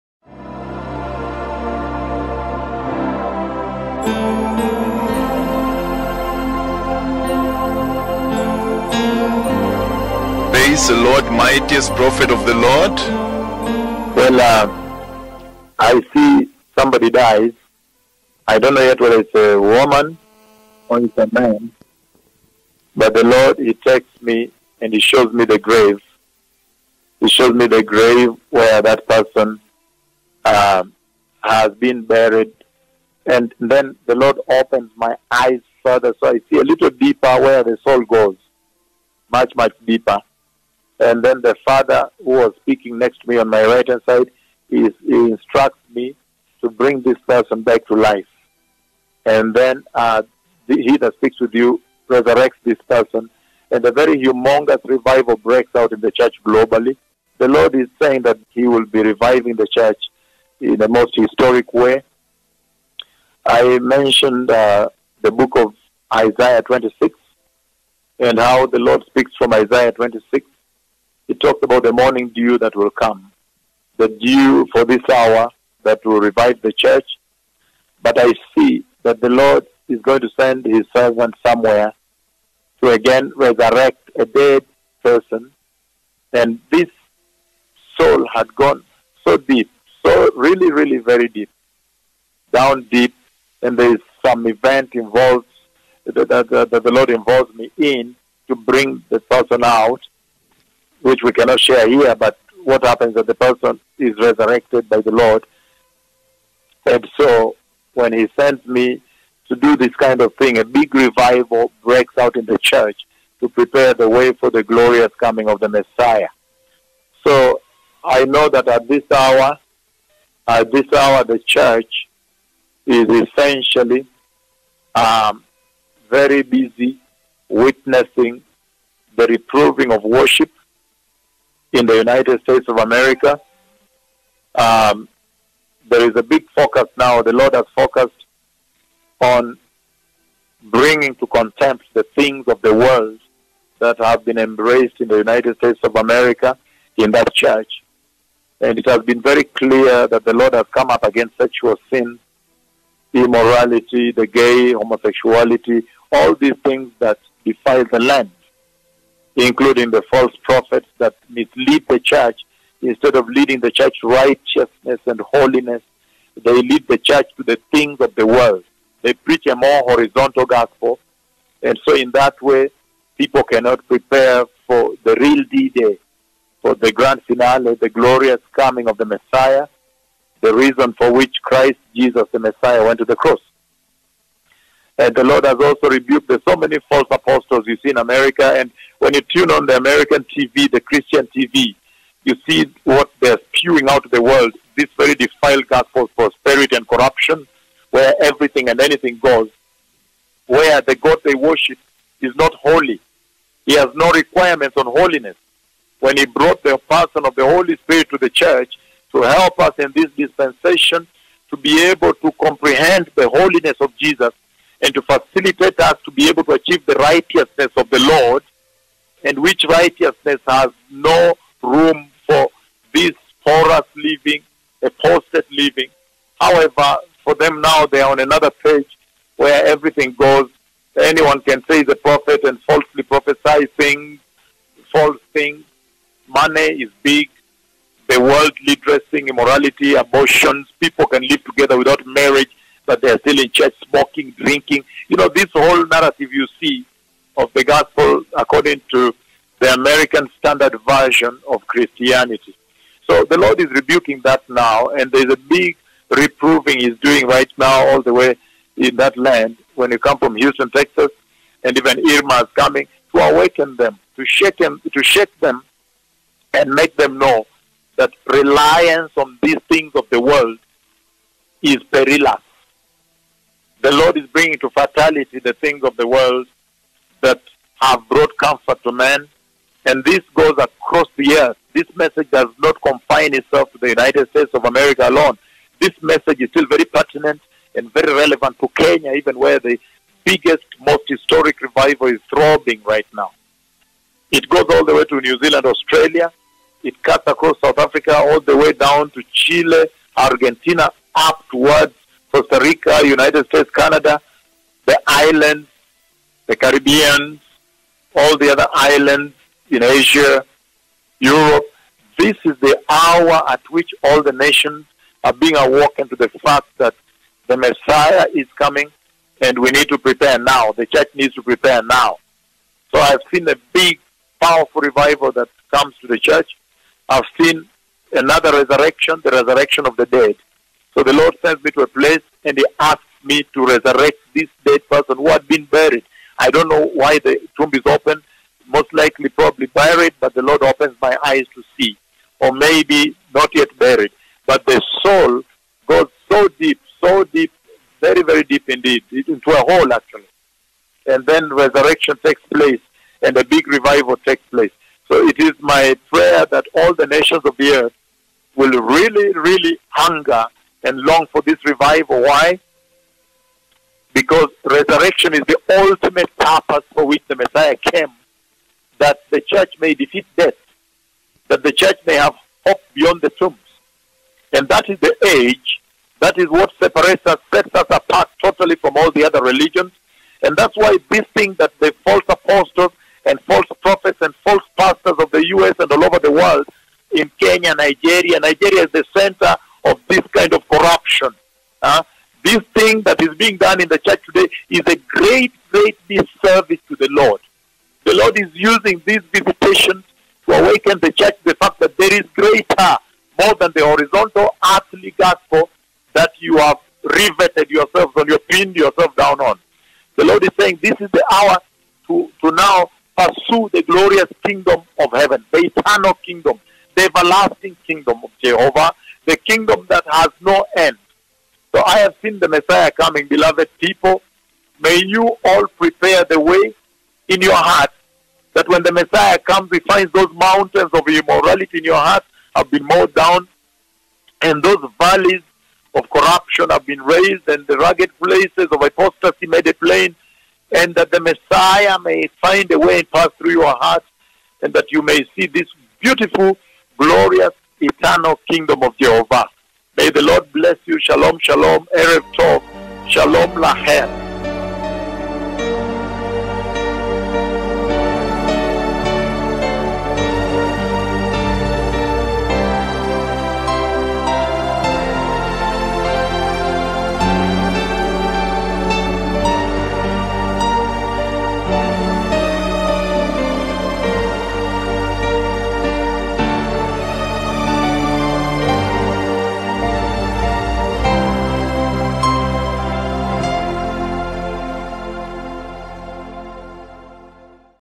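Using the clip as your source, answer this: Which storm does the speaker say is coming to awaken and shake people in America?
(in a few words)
Irma.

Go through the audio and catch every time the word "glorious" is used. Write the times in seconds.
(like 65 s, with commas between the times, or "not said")
114 s, 177 s, 413 s, 446 s.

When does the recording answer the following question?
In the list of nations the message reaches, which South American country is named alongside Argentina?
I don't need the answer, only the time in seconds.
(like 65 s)
299 s.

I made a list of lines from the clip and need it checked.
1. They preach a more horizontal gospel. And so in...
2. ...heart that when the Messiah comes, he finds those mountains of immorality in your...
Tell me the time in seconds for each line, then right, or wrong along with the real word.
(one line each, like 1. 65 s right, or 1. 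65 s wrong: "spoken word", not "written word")
1. 169 s right
2. 427 s right.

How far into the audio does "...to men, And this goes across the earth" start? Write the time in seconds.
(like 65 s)
278 s.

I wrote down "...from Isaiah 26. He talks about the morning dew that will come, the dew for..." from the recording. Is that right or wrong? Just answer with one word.
right.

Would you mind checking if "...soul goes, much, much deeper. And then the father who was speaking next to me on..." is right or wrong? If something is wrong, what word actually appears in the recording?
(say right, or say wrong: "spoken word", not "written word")
right.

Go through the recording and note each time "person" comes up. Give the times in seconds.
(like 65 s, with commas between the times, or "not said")
29 s, 47 s, 52 s, 85 s, 99 s, 103 s, 206 s, 334 s.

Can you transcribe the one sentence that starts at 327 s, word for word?
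I've seen another resurrection, the resurrection of the dead.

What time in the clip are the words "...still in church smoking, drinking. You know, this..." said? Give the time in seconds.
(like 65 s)
243 s.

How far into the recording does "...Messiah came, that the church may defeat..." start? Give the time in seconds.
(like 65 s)
367 s.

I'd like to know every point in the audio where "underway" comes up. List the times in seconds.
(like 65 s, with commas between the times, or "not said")
not said.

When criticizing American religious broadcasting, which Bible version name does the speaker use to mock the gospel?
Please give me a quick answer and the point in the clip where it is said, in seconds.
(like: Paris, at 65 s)
American Standard Version, at 249 s.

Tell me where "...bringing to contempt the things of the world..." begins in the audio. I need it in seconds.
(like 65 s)
140 s.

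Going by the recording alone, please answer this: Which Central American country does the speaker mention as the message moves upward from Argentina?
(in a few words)
Costa Rica.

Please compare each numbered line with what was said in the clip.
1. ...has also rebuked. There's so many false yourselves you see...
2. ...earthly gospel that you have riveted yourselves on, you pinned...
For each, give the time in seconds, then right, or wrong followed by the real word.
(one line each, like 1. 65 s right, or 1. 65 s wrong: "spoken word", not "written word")
1. 185 s wrong: "apostles", not "yourselves"
2. 404 s right.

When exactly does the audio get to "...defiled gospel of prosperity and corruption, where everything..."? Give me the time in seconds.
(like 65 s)
195 s.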